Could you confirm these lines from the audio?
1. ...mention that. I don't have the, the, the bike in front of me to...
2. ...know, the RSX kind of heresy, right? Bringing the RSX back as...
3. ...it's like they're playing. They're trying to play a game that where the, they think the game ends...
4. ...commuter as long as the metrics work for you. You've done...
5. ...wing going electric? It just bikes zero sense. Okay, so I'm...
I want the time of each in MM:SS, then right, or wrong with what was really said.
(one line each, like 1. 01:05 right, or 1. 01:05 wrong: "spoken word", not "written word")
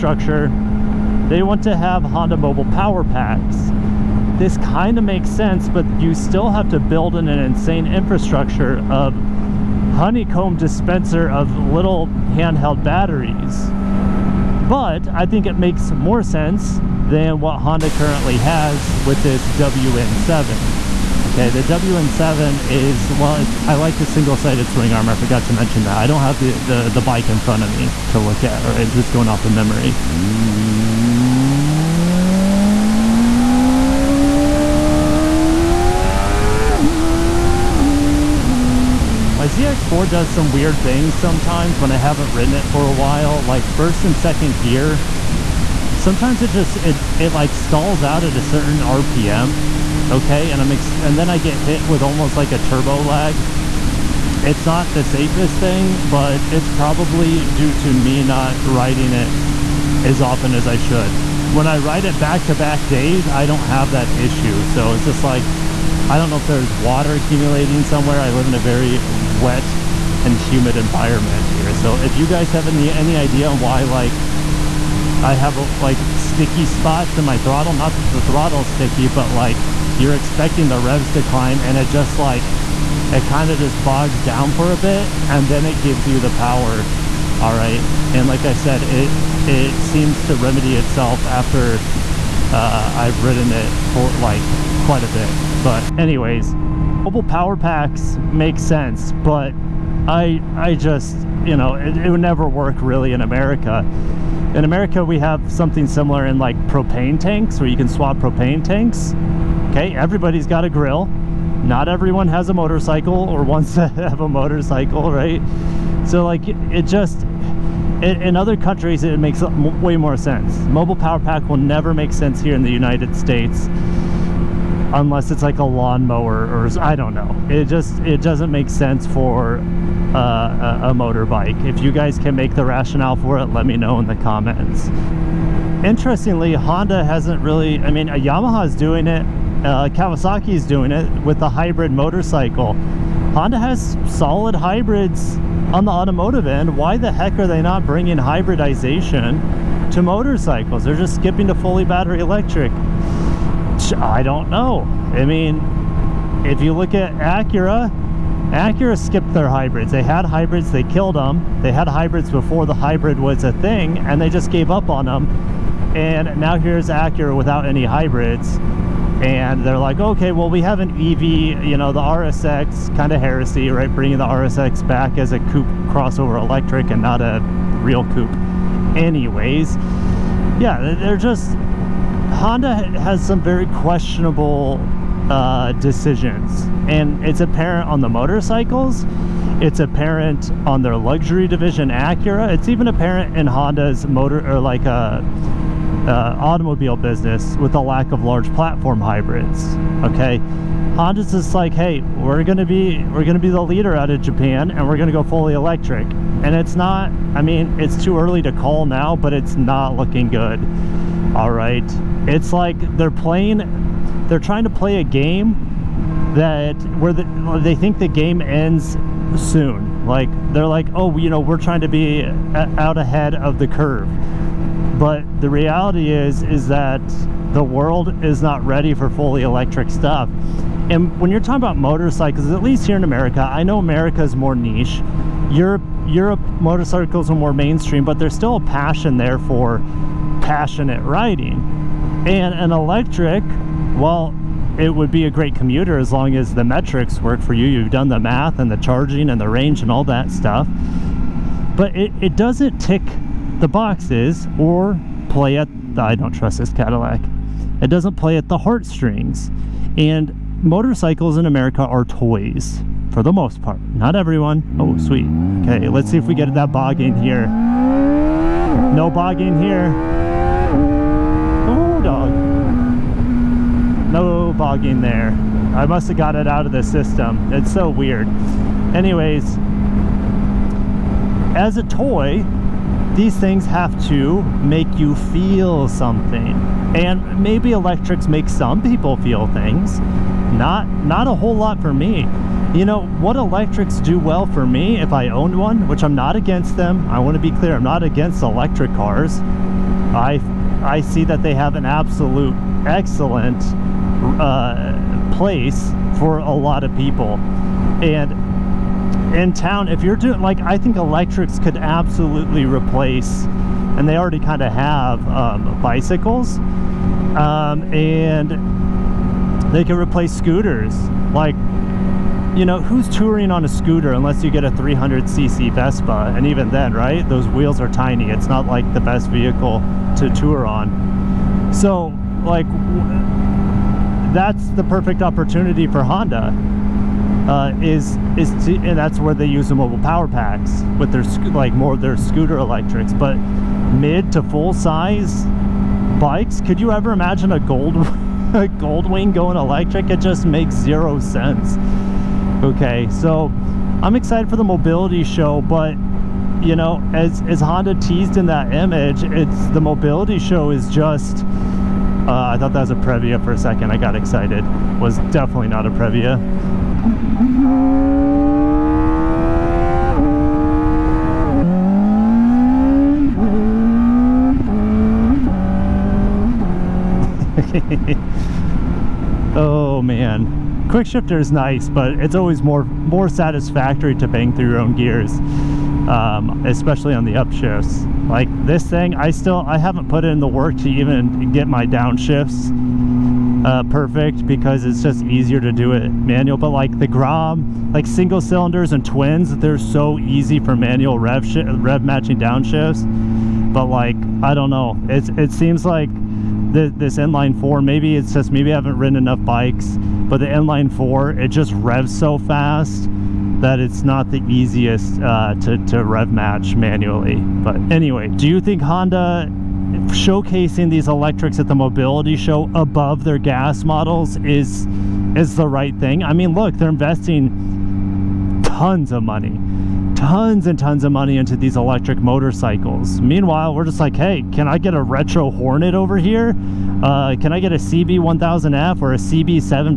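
1. 00:25 right
2. 02:51 right
3. 03:32 right
4. 04:05 right
5. 05:49 wrong: "makes", not "bikes".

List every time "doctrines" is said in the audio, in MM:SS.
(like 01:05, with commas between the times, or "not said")
not said.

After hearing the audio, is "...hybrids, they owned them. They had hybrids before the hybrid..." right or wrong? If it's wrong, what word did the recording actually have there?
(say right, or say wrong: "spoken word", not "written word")
wrong: "killed", not "owned".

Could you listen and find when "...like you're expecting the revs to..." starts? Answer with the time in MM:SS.
01:19.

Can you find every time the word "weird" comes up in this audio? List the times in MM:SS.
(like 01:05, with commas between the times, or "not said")
00:40, 04:37.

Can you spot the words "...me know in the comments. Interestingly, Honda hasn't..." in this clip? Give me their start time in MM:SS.
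02:13.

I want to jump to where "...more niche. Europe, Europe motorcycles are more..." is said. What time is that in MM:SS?
03:54.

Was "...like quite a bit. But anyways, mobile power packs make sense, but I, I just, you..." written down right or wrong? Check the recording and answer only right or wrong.
right.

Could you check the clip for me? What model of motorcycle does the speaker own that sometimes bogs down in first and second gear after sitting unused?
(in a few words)
ZX4.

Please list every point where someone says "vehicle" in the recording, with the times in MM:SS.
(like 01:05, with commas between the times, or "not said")
05:29.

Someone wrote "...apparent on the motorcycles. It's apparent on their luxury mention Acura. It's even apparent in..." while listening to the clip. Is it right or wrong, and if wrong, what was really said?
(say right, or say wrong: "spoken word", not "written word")
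wrong: "division", not "mention".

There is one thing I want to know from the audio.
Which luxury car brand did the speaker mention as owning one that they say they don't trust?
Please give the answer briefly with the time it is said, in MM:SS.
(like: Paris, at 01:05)
Cadillac, at 04:16.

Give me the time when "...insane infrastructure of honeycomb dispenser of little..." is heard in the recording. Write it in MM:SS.
00:07.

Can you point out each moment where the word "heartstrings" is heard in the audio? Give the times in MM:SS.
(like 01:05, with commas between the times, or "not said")
04:18.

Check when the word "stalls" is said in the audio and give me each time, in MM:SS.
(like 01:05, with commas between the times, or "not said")
00:47.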